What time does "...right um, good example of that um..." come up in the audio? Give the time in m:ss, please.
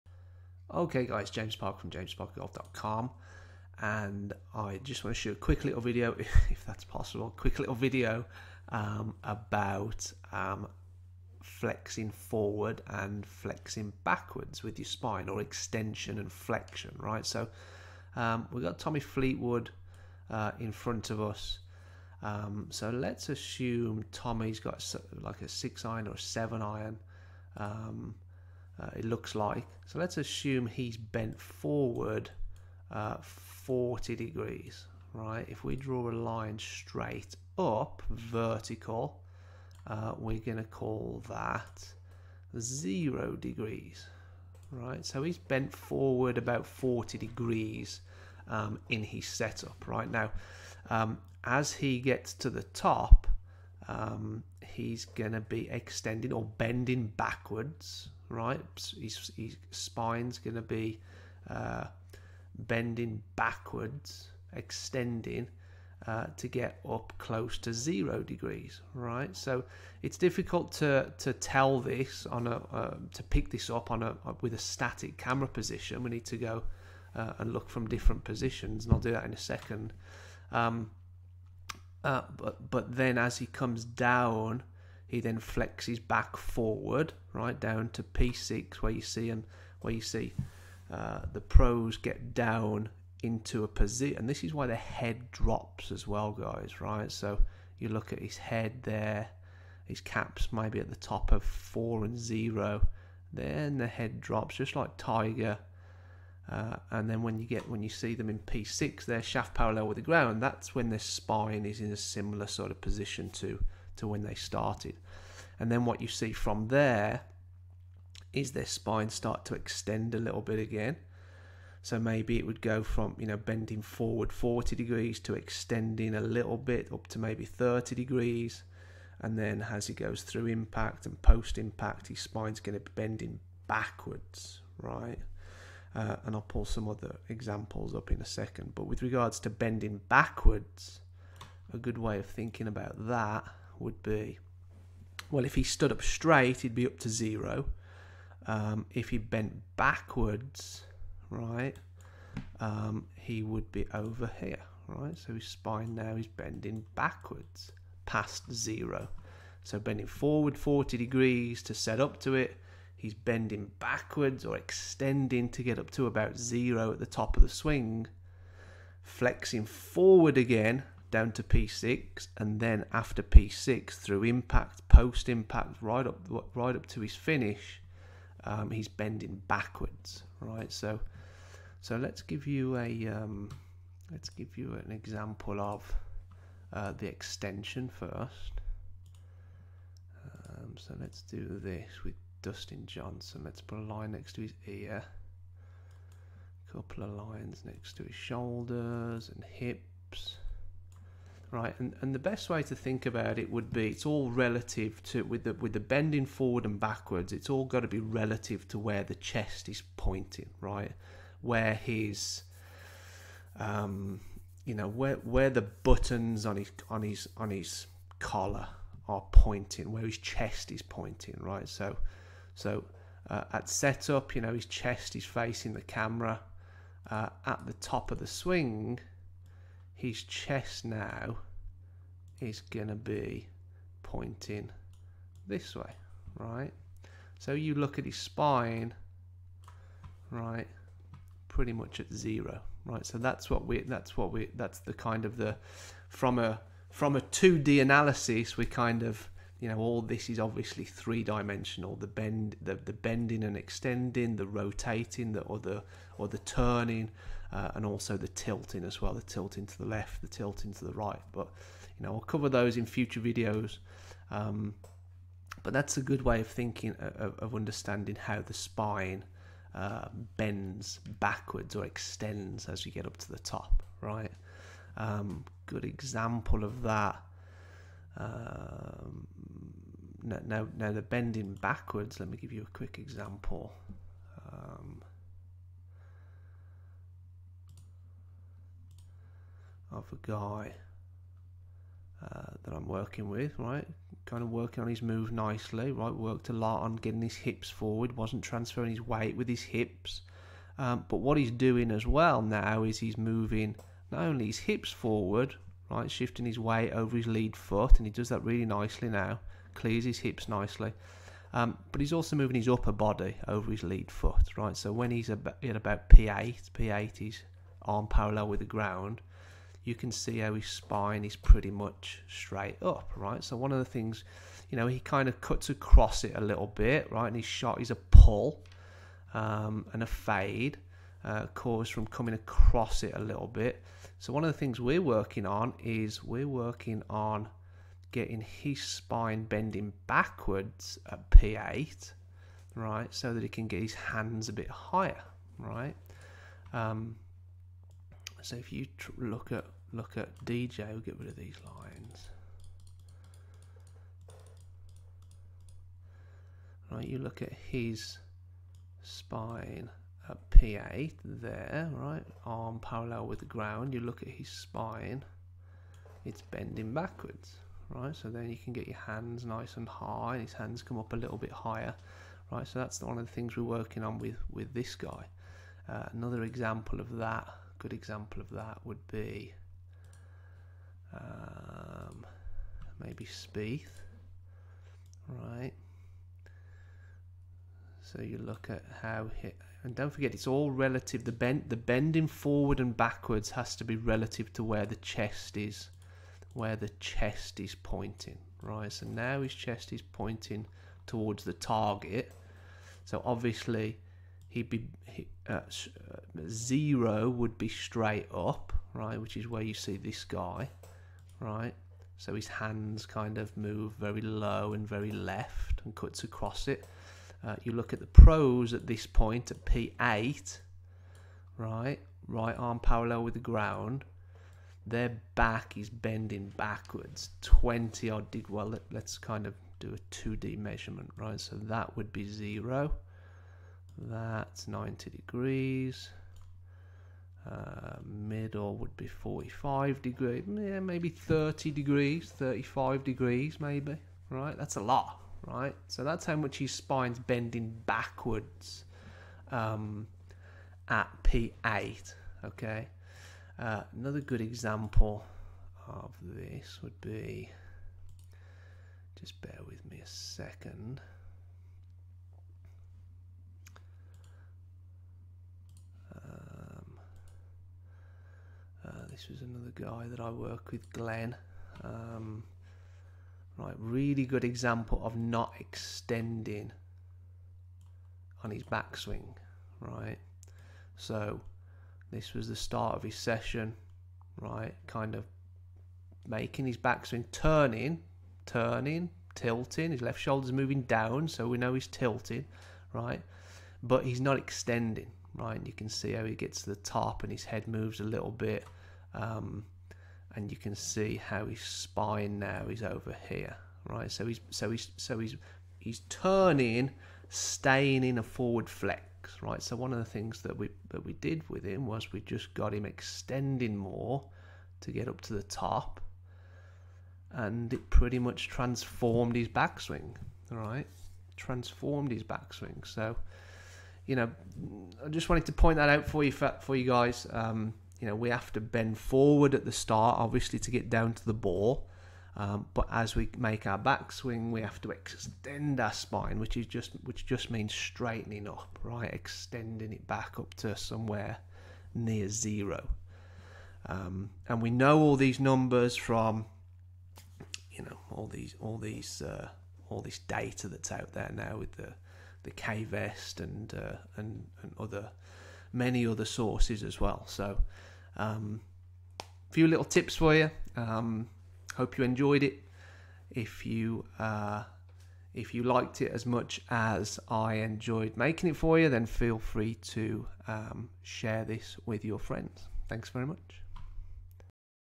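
4:34.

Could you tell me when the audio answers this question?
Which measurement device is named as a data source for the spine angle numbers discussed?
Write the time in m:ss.
9:12.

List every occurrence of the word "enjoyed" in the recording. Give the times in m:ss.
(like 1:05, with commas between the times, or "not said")
9:22, 9:27.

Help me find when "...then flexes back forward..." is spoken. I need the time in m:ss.
1:25.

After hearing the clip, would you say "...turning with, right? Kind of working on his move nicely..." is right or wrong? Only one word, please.
wrong.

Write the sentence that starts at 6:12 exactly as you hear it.
So that's one of the things we're working on with, with this guy.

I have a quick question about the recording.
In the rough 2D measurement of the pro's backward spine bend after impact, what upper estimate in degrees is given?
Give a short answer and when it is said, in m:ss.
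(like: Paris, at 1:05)
35 degrees, at 7:22.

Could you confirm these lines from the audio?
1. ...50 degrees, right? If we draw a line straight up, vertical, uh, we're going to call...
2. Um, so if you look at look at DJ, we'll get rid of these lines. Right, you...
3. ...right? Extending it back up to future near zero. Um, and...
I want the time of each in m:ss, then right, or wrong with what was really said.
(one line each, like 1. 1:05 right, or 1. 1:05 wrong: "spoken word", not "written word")
1. 0:33 wrong: "40", not "50"
2. 5:46 right
3. 8:58 wrong: "somewhere", not "future".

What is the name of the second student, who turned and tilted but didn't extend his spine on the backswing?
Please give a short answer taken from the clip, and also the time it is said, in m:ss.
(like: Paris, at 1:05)
Glenn, at 7:50.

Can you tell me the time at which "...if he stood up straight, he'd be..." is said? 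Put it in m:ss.
2:25.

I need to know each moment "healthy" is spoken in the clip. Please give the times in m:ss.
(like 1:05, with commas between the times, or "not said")
not said.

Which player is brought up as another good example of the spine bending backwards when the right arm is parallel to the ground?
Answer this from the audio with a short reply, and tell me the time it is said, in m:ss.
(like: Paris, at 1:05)
Spieth, at 6:23.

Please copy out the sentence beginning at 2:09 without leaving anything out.
And then as he goes through impact and post impact, his spine's going to be bending backwards, right?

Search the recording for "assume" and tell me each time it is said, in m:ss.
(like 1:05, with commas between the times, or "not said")
0:23, 0:30.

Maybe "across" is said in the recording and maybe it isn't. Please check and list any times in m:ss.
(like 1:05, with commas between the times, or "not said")
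5:25, 5:32, 6:56.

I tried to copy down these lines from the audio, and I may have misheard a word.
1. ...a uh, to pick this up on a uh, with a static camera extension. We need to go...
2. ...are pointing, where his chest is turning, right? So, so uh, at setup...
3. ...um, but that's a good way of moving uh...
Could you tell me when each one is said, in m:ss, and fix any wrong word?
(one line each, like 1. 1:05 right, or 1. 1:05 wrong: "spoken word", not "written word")
1. 1:12 wrong: "position", not "extension"
2. 3:39 wrong: "pointing", not "turning"
3. 4:24 wrong: "thinking", not "moving".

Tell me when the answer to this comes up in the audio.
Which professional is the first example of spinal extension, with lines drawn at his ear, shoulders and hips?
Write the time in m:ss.
3:12.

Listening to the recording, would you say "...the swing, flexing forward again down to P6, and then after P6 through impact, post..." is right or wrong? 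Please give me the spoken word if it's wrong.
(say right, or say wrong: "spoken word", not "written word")
right.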